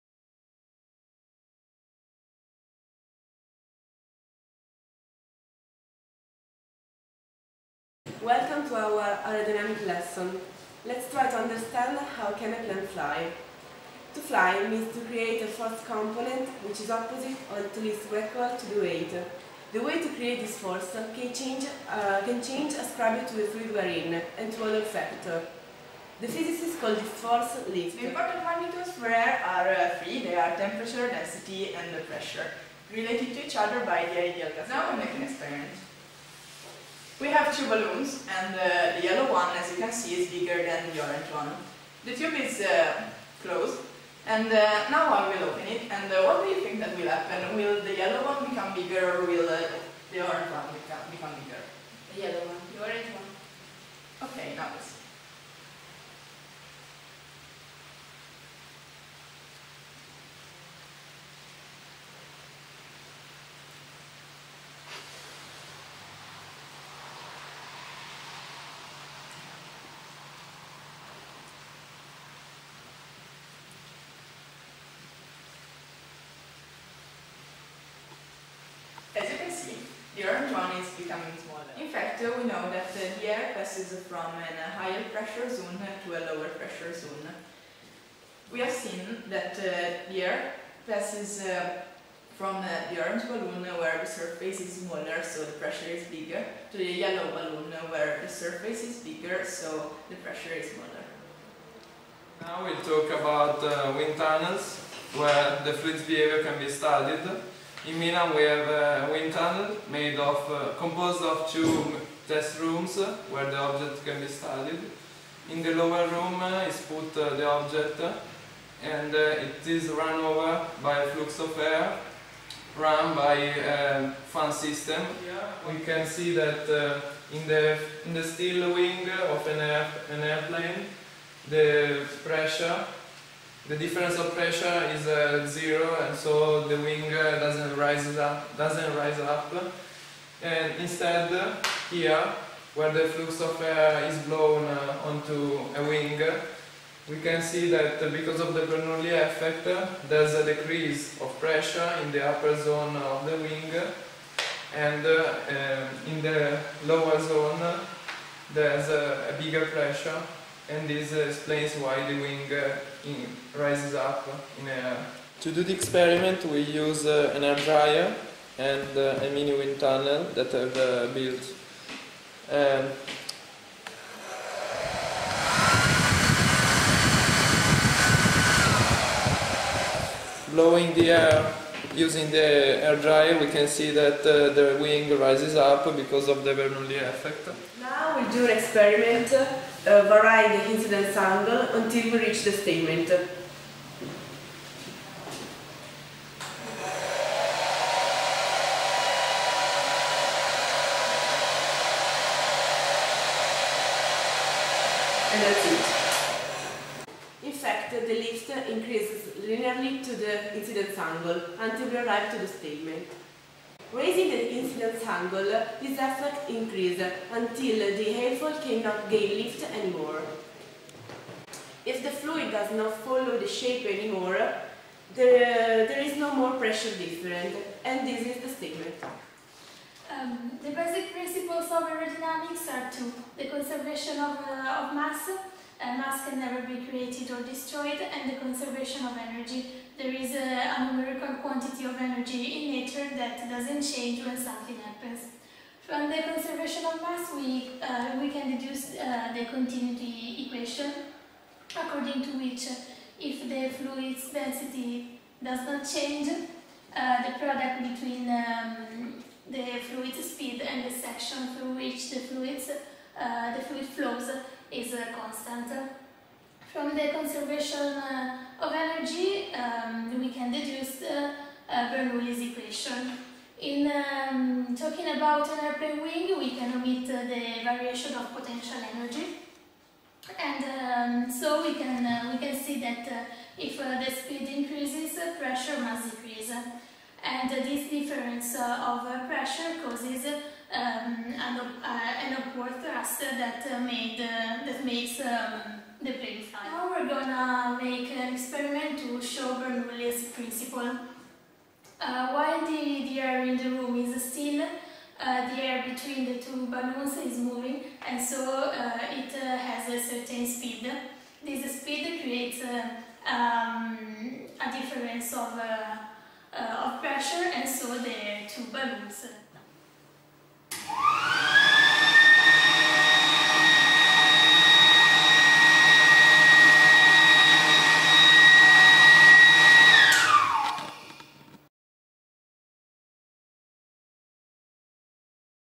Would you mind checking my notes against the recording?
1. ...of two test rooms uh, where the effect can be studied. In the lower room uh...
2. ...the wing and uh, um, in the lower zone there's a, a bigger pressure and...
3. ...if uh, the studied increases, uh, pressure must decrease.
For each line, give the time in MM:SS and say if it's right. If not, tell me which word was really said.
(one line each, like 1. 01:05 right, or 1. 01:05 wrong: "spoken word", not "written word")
1. 01:51 wrong: "object", not "effect"
2. 02:33 right
3. 04:43 wrong: "speed", not "studied".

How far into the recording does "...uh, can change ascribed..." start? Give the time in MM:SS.
00:21.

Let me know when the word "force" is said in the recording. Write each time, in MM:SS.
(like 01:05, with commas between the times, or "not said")
00:15, 00:20, 00:27.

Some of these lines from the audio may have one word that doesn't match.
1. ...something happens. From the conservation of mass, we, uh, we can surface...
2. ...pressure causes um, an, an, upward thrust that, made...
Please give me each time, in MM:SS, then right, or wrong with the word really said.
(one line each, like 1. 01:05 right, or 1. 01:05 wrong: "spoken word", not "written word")
1. 04:04 wrong: "deduce", not "surface"
2. 04:49 right.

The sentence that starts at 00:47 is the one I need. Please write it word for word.
Will the yellow one become bigger, or will uh, the orange one become, bigger?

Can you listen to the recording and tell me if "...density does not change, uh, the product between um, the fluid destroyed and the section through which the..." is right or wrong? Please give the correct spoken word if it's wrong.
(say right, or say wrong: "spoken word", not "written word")
wrong: "speed", not "destroyed".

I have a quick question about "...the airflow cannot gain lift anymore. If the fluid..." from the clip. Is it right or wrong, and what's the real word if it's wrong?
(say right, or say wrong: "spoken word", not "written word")
right.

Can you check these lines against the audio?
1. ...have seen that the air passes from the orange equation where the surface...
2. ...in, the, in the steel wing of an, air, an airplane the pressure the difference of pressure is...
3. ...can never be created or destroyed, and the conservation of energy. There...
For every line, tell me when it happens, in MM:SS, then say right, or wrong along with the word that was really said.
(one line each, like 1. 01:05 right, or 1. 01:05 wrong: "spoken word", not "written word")
1. 01:28 wrong: "balloon", not "equation"
2. 02:07 right
3. 03:56 right.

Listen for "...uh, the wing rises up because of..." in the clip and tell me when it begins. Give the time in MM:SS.
03:04.